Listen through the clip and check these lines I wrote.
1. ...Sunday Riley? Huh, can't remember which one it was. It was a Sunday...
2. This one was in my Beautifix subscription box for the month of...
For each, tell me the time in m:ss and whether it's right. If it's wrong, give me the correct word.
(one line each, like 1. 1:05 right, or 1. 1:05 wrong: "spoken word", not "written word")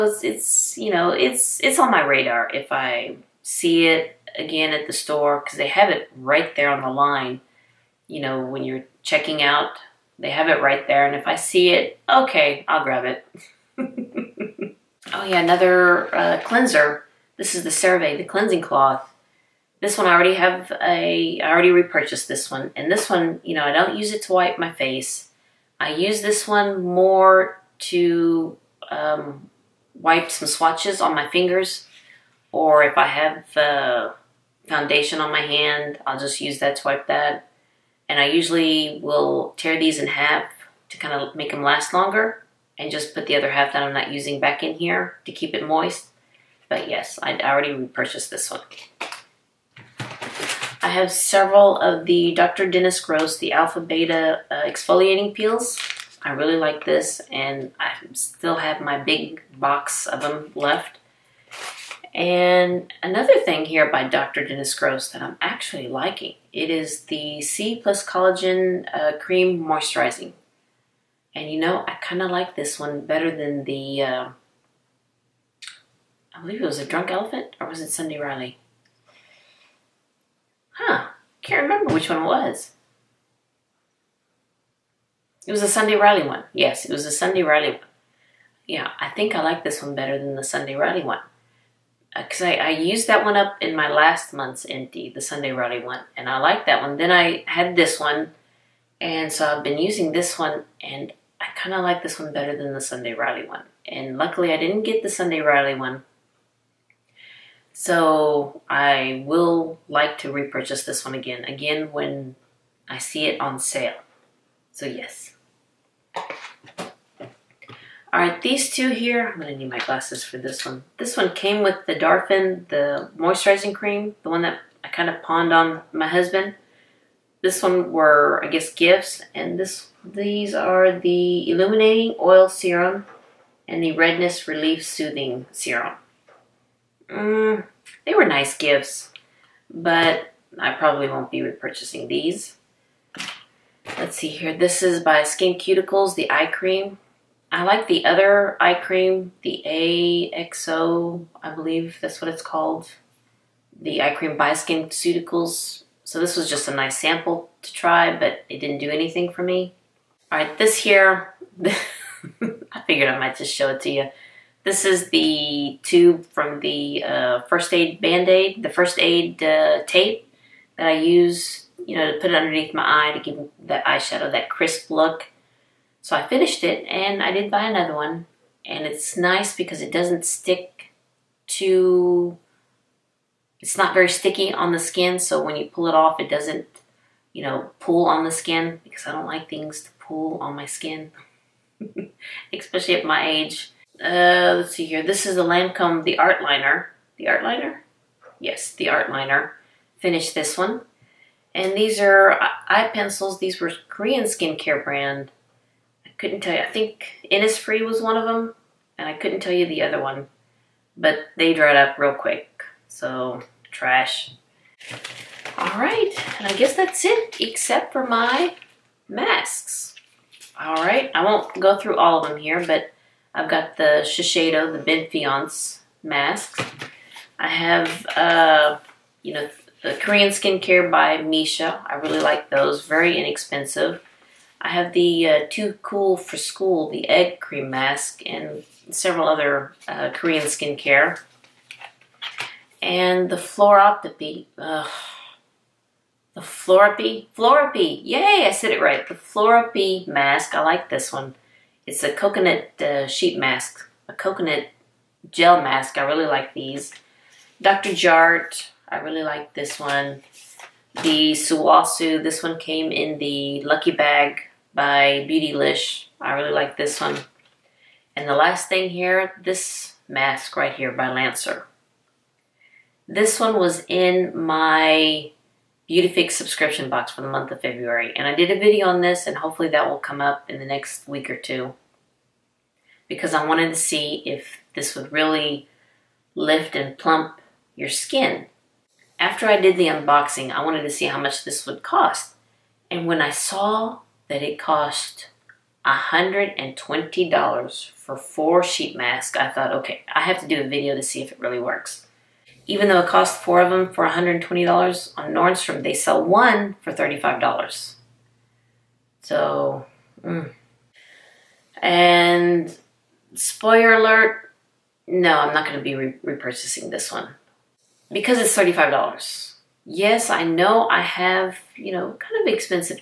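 1. 1:17 right
2. 4:33 right.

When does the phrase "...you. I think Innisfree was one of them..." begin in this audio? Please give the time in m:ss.
3:26.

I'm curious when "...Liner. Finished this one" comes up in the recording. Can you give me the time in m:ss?
3:19.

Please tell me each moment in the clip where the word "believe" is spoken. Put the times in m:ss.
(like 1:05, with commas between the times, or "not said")
1:16, 2:31.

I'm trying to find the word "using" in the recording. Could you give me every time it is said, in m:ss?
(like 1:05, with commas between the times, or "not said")
0:44, 1:39.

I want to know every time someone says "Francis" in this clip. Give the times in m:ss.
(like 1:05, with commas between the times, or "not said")
not said.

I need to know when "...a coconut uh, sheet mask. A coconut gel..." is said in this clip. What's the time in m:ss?
4:12.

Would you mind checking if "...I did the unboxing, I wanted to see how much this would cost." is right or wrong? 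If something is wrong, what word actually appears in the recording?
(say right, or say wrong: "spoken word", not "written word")
right.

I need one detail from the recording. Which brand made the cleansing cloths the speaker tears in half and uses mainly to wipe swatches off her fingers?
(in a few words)
CeraVe.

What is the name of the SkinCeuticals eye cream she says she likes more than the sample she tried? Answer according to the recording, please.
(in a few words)
AXO.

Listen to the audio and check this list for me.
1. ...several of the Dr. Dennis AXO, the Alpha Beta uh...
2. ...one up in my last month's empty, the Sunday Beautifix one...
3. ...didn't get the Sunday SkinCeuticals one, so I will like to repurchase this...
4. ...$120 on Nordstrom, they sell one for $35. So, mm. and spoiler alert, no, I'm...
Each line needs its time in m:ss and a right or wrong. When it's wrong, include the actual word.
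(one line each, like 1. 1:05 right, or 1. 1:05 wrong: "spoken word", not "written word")
1. 0:51 wrong: "Gross", not "AXO"
2. 1:33 wrong: "Riley", not "Beautifix"
3. 1:44 wrong: "Riley", not "SkinCeuticals"
4. 5:04 right.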